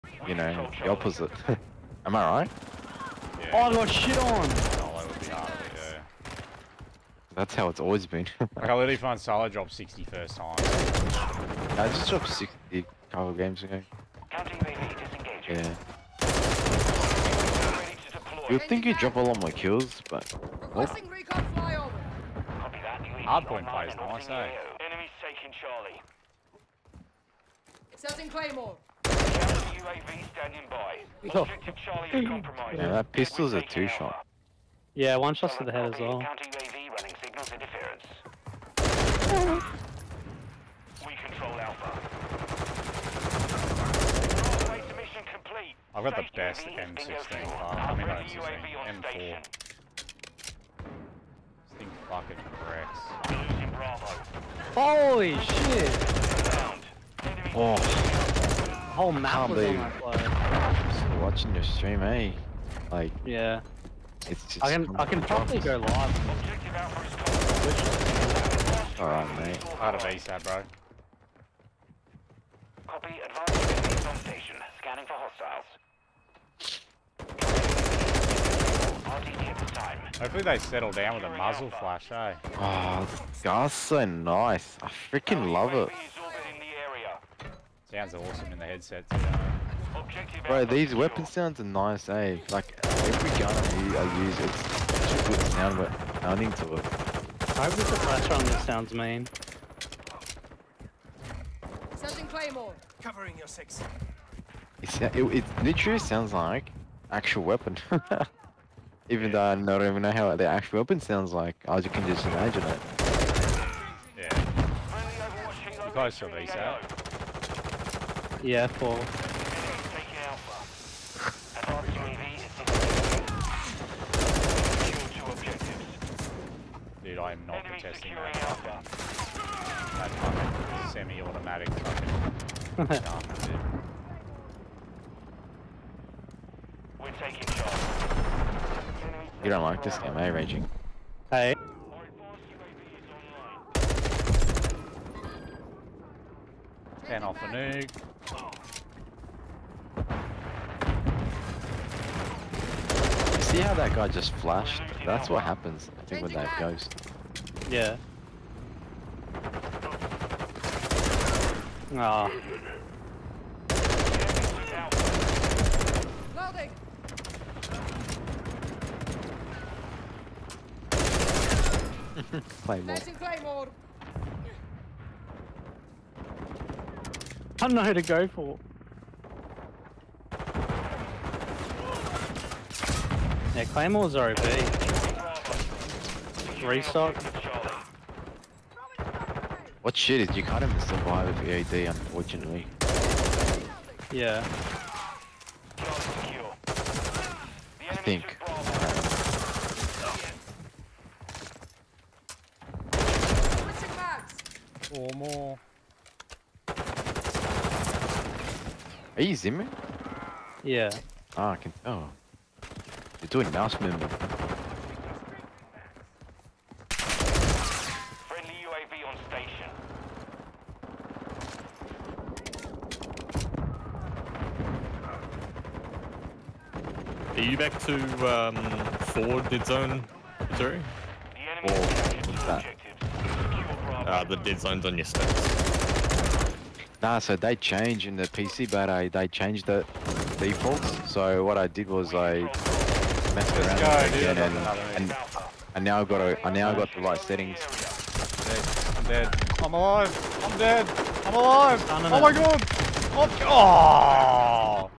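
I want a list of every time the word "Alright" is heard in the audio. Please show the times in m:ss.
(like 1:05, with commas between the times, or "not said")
1:08.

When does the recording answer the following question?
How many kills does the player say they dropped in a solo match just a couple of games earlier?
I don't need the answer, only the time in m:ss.
0:12.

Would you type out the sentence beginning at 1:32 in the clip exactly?
Like, every gun I use, it's such a good sound, but nothing to it.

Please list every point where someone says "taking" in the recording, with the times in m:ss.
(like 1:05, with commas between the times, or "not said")
0:25, 2:17.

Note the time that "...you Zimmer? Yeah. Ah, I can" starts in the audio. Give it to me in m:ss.
3:29.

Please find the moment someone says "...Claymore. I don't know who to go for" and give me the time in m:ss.
2:53.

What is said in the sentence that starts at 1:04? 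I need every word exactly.
I can I can probably go live.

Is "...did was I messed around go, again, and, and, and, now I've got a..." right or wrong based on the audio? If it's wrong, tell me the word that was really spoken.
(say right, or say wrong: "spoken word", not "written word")
right.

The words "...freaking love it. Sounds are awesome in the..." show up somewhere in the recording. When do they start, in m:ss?
1:25.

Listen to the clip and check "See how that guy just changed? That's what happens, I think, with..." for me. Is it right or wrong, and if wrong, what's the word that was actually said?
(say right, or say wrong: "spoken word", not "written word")
wrong: "flashed", not "changed".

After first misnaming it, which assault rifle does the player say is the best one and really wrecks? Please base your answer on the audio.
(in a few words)
M4.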